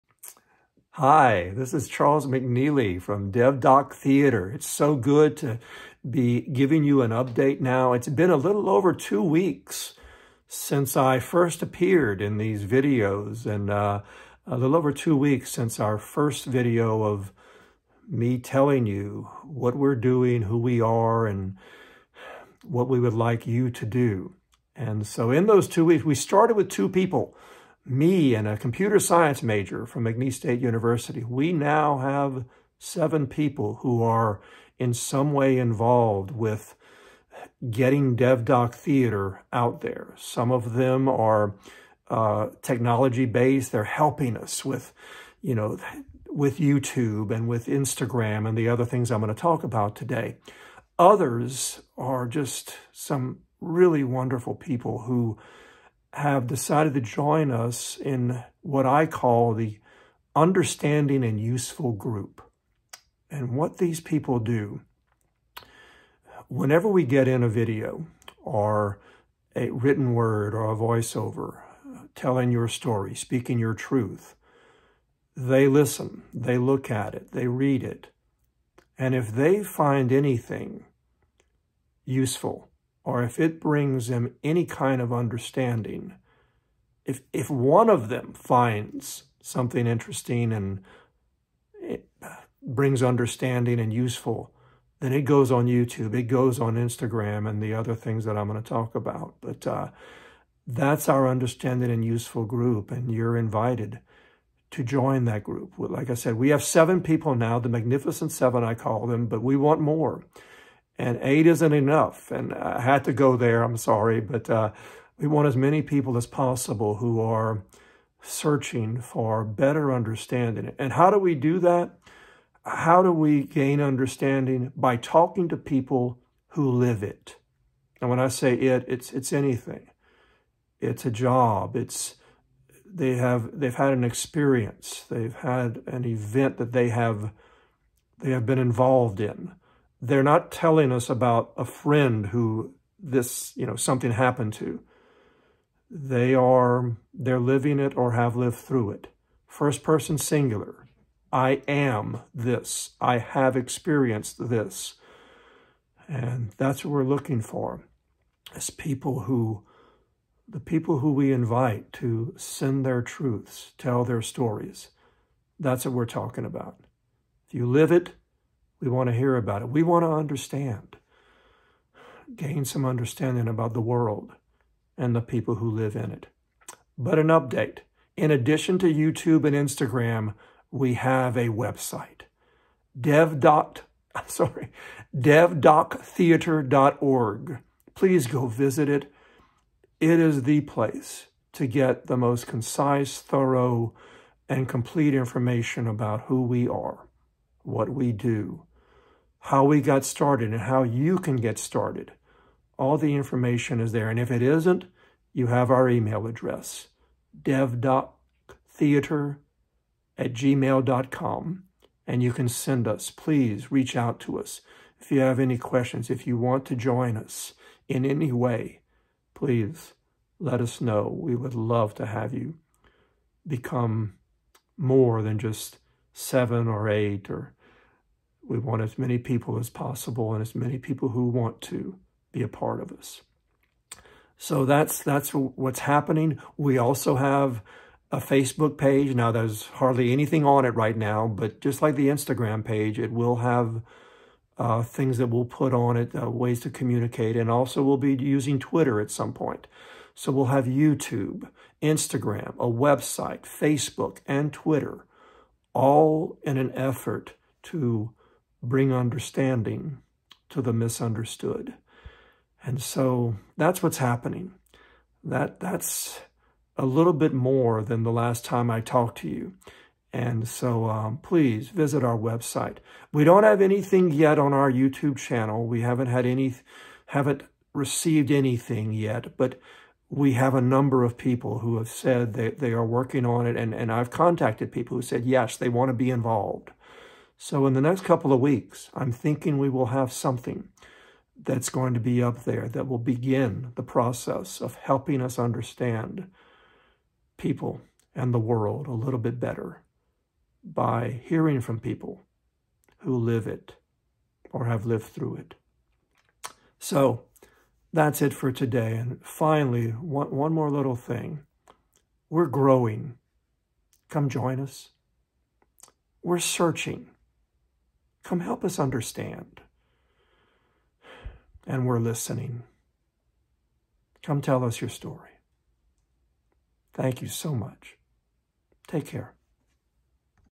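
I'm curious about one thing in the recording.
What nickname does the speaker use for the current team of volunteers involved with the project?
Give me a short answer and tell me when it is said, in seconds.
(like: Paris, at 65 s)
the Magnificent Seven, at 107 s.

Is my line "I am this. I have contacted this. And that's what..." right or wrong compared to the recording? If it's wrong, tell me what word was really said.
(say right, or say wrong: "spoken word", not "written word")
wrong: "experienced", not "contacted".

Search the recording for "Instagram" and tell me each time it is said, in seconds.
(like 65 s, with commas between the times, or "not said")
47 s, 96 s, 179 s, 242 s, 251 s.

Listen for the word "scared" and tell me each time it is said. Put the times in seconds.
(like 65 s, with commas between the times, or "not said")
not said.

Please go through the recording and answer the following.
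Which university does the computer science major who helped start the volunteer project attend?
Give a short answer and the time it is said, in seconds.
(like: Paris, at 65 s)
McNeese State University, at 30 s.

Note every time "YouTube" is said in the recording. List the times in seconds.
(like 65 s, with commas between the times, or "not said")
46 s, 95 s, 178 s, 250 s, 274 s.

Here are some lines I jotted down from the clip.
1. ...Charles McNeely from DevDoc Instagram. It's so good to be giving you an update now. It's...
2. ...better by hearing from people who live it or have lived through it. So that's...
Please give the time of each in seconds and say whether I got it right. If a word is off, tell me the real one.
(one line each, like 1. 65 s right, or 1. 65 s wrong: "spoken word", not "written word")
1. 1 s wrong: "Theatre", not "Instagram"
2. 299 s right.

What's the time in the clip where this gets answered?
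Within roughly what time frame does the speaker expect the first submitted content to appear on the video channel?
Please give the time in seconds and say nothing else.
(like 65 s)
287 s.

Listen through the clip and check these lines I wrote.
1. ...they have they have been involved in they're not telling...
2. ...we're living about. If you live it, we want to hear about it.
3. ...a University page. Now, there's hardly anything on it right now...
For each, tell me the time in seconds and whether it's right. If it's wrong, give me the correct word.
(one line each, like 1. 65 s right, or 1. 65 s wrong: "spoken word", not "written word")
1. 136 s right
2. 165 s wrong: "talking", not "living"
3. 238 s wrong: "Facebook", not "University".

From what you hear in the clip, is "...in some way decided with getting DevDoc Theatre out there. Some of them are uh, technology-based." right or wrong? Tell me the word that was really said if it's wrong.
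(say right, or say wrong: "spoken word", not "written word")
wrong: "involved", not "decided".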